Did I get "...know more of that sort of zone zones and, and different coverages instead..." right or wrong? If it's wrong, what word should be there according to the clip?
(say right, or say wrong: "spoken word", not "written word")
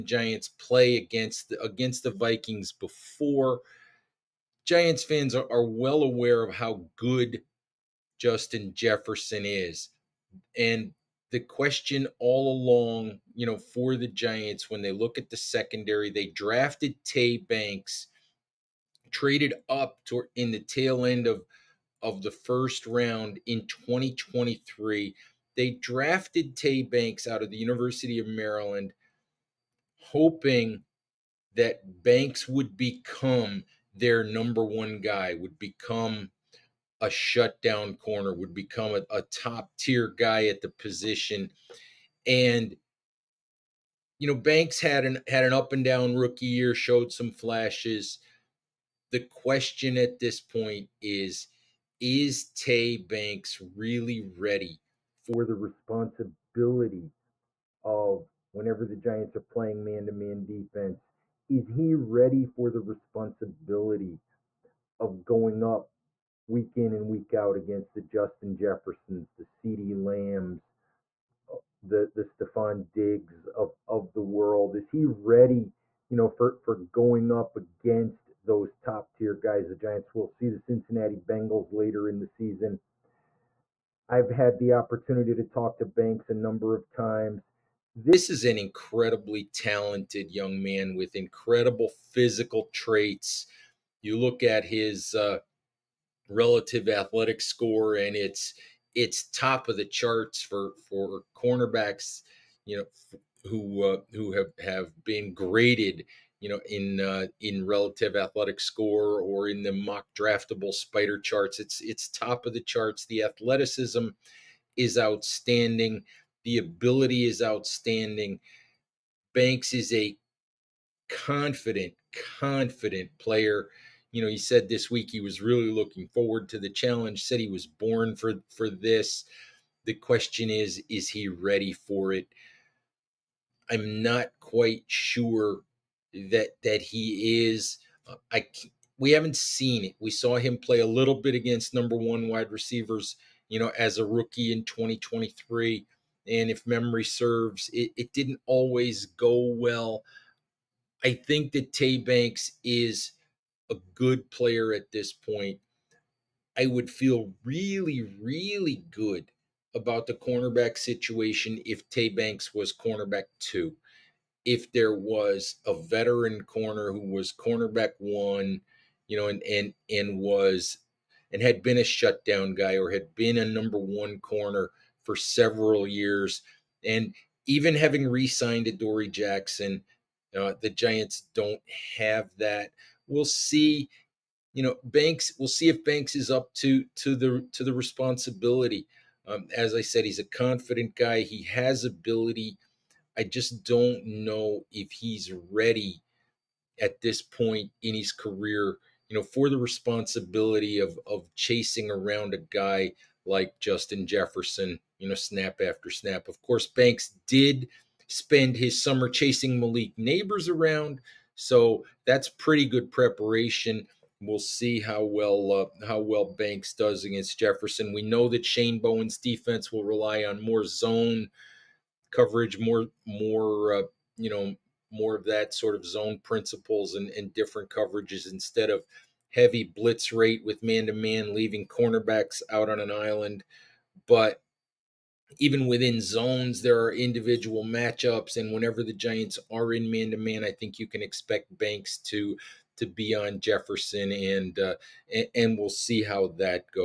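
wrong: "principles", not "zones".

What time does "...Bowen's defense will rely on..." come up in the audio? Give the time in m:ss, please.
3:38.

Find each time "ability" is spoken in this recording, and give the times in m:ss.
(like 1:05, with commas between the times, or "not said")
1:56, 3:11.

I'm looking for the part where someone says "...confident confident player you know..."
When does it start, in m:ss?
2:01.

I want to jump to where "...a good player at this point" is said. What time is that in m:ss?
2:33.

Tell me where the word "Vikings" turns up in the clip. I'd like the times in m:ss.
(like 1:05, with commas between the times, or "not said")
0:02.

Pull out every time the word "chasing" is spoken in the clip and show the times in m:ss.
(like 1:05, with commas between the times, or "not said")
3:21, 3:29.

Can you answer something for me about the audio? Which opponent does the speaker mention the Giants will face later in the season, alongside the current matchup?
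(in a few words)
Cincinnati Bengals.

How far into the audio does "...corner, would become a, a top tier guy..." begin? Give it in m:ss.
0:37.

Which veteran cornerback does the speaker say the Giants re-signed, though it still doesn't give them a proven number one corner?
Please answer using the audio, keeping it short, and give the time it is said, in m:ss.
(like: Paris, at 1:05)
Dory Jackson, at 2:58.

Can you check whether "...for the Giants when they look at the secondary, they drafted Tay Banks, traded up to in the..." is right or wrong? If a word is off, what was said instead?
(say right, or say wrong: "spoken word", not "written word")
right.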